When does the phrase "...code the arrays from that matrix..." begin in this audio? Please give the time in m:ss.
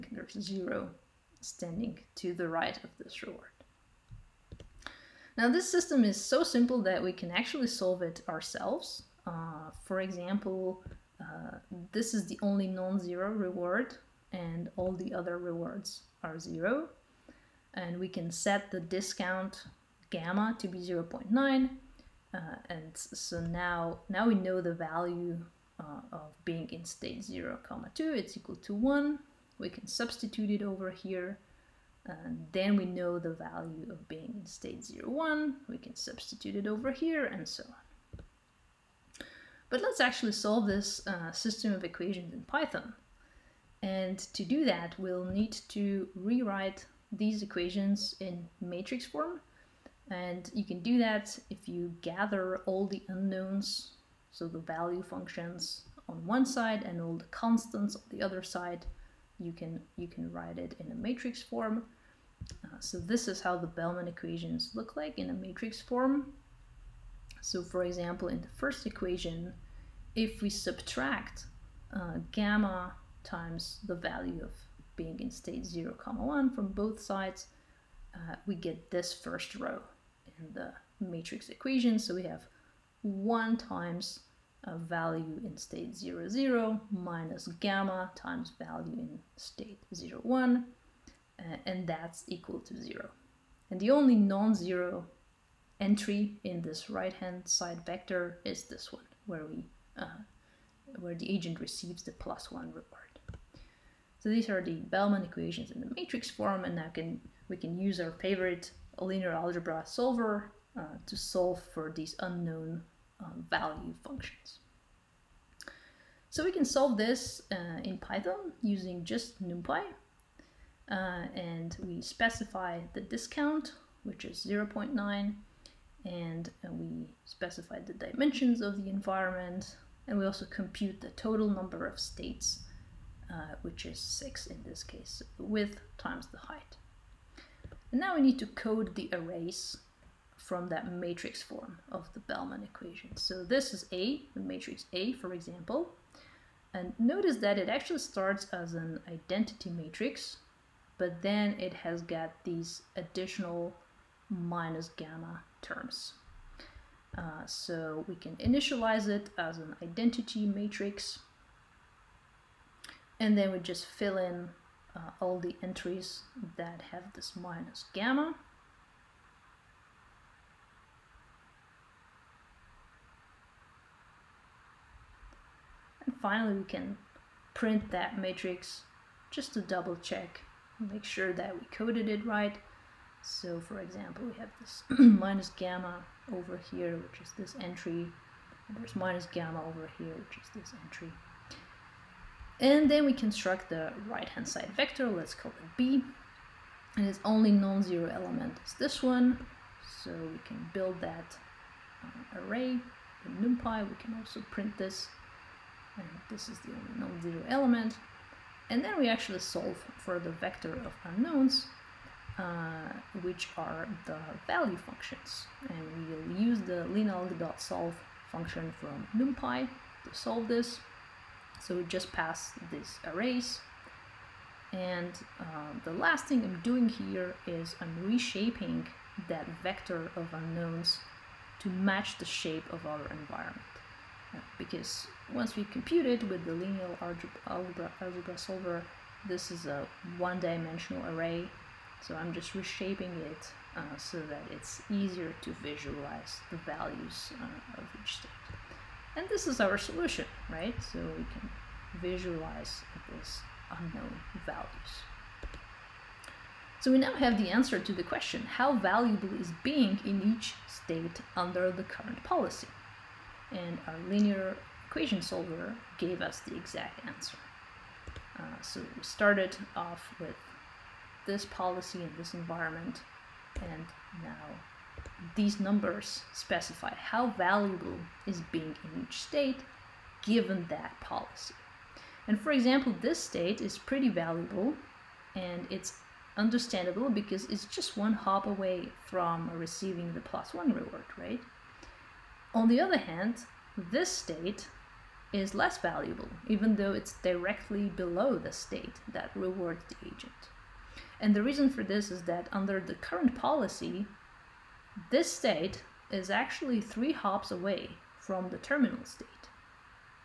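2:18.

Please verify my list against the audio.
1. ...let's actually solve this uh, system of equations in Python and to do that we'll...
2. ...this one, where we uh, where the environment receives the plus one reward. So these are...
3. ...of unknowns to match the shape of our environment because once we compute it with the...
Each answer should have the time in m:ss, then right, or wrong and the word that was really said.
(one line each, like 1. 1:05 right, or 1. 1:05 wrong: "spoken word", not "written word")
1. 0:39 right
2. 1:38 wrong: "agent", not "environment"
3. 3:50 right.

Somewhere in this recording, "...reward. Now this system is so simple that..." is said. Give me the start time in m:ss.
0:03.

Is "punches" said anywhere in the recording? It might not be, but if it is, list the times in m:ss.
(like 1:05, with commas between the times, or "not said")
not said.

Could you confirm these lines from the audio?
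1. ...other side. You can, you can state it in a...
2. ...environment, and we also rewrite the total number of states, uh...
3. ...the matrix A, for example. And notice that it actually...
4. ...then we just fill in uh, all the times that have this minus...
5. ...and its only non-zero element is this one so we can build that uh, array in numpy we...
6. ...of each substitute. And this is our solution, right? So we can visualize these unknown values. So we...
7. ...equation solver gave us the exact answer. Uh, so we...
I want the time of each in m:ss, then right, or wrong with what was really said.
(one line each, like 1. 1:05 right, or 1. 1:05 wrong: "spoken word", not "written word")
1. 0:58 wrong: "write", not "state"
2. 2:08 wrong: "compute", not "rewrite"
3. 2:24 right
4. 2:43 wrong: "entries", not "times"
5. 3:16 right
6. 4:07 wrong: "state", not "substitute"
7. 4:24 right.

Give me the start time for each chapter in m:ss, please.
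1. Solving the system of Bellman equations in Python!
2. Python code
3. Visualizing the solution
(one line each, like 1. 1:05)
1. 0:39
2. 1:55
3. 4:15.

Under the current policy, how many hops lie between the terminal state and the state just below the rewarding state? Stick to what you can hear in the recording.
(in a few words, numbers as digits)
3.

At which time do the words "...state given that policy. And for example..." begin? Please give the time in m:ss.
4:39.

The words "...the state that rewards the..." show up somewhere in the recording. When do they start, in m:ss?
4:58.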